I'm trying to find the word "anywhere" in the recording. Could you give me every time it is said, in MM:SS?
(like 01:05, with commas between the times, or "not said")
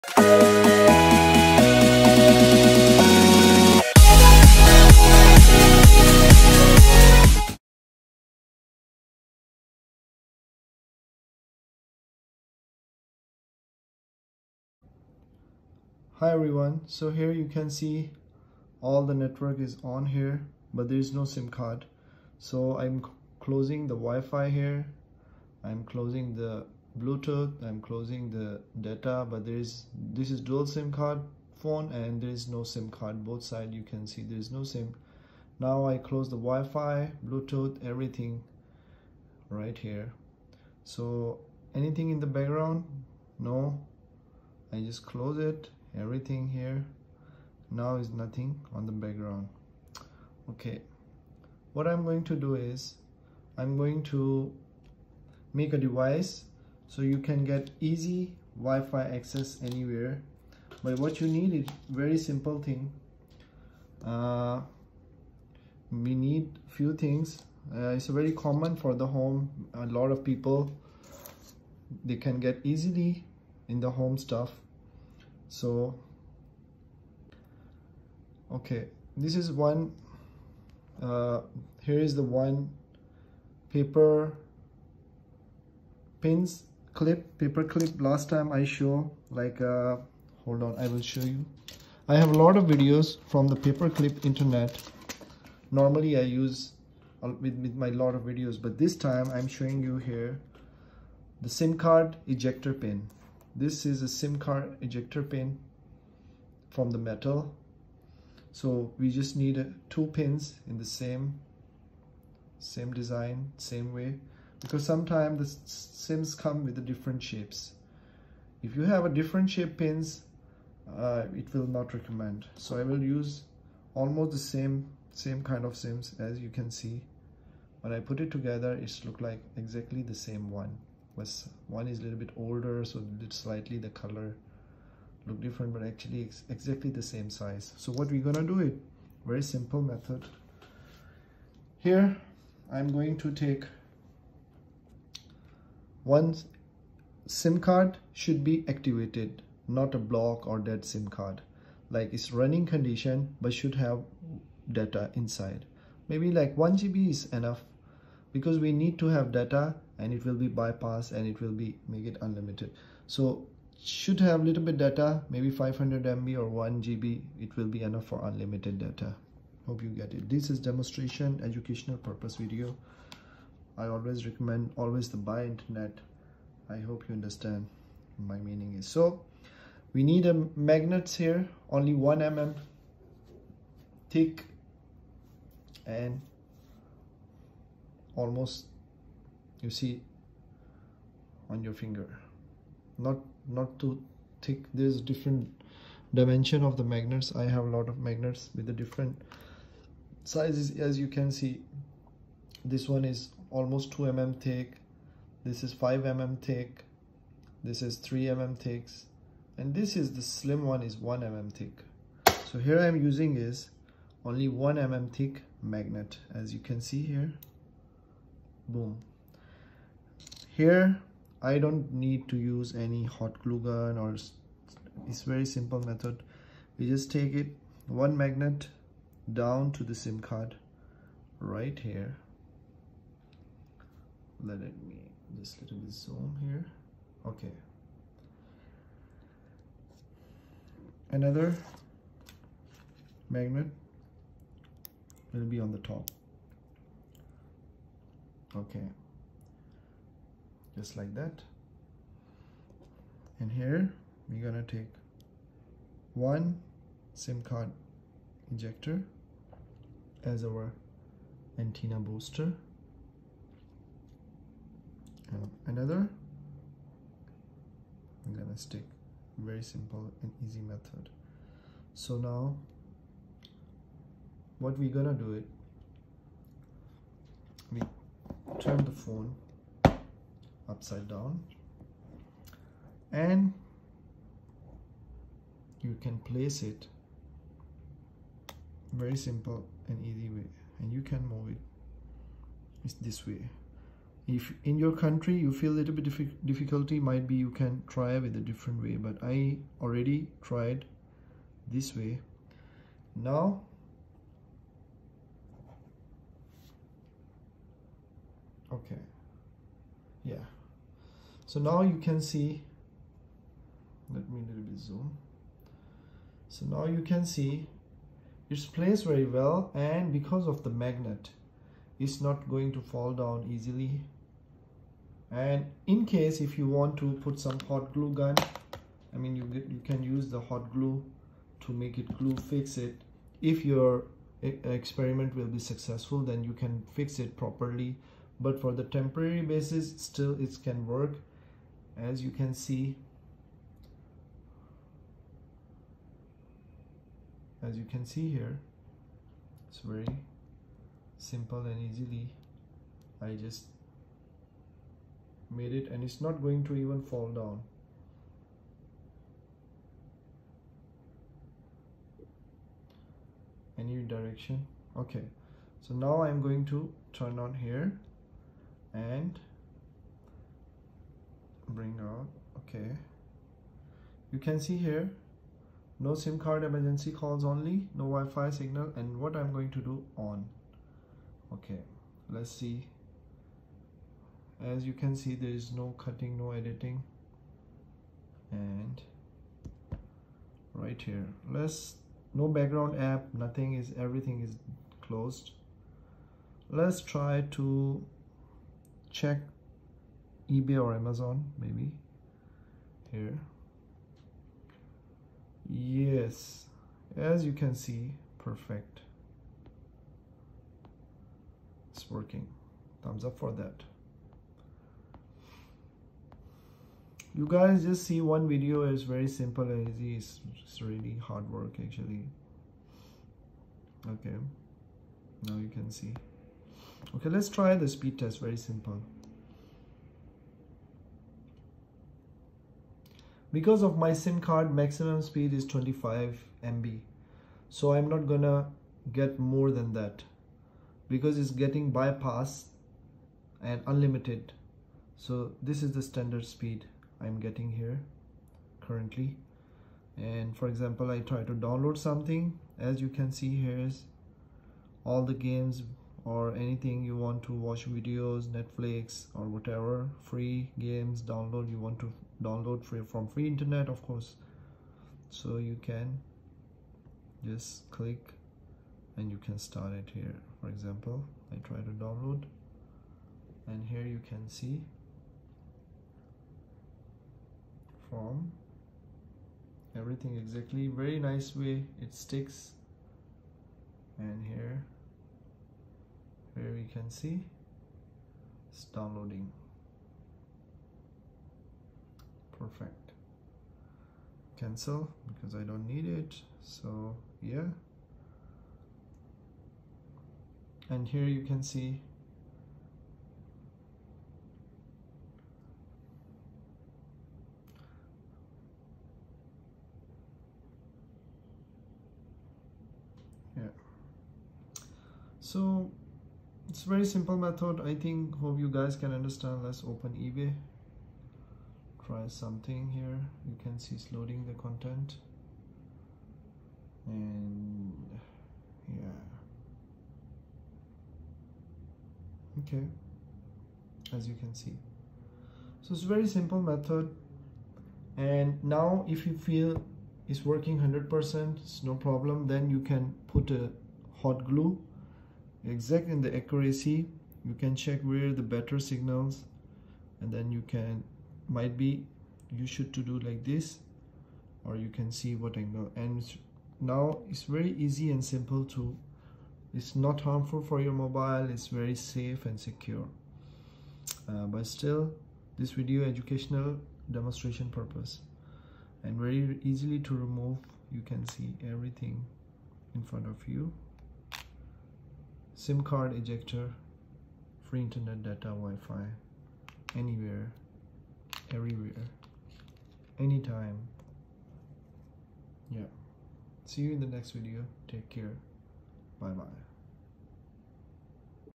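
00:59, 09:39.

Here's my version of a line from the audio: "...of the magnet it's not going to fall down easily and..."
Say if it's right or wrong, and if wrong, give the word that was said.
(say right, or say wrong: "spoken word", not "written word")
right.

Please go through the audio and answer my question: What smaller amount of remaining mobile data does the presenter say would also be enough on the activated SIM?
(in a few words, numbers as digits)
500 MB.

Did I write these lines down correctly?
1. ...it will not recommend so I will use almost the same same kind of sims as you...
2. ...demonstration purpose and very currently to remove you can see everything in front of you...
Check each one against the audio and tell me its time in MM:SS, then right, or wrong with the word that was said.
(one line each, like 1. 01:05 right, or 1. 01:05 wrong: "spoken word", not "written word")
1. 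02:01 right
2. 09:27 wrong: "easily", not "currently".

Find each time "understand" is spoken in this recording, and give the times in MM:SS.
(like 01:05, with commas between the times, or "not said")
02:57, 08:39.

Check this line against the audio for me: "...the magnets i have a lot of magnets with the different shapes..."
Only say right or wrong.
wrong.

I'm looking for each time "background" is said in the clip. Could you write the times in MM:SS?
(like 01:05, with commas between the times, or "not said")
00:42, 00:48, 06:32.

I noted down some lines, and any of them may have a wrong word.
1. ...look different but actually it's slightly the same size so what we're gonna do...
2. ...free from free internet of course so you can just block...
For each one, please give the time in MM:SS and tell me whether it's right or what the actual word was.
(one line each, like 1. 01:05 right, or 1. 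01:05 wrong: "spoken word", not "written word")
1. 02:15 wrong: "exactly", not "slightly"
2. 07:42 wrong: "click", not "block".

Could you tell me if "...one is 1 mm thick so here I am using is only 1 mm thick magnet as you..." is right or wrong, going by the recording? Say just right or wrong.
right.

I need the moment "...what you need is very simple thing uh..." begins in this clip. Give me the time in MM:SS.
01:00.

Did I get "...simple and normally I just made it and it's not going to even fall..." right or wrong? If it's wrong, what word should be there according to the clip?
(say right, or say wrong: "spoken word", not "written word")
wrong: "easily", not "normally".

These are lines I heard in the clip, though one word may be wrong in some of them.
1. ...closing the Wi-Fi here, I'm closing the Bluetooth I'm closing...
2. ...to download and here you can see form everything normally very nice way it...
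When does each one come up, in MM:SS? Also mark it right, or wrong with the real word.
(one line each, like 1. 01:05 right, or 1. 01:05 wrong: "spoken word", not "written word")
1. 00:23 right
2. 07:51 wrong: "exactly", not "normally".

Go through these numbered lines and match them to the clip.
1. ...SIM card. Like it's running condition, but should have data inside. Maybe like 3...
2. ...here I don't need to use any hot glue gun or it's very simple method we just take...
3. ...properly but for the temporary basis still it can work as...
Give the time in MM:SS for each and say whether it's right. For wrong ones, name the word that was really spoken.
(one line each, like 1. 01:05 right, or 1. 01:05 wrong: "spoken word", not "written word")
1. 02:30 wrong: "1", not "3"
2. 03:40 right
3. 05:37 right.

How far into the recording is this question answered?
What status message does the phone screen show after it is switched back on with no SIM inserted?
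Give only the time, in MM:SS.
06:16.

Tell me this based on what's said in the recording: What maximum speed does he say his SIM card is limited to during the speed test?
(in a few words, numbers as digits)
25 MB.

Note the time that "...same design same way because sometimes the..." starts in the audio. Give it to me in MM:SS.
01:52.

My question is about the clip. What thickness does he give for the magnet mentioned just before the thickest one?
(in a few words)
2 mm.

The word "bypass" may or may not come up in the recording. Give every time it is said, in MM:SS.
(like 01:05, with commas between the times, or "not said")
02:40, 07:21.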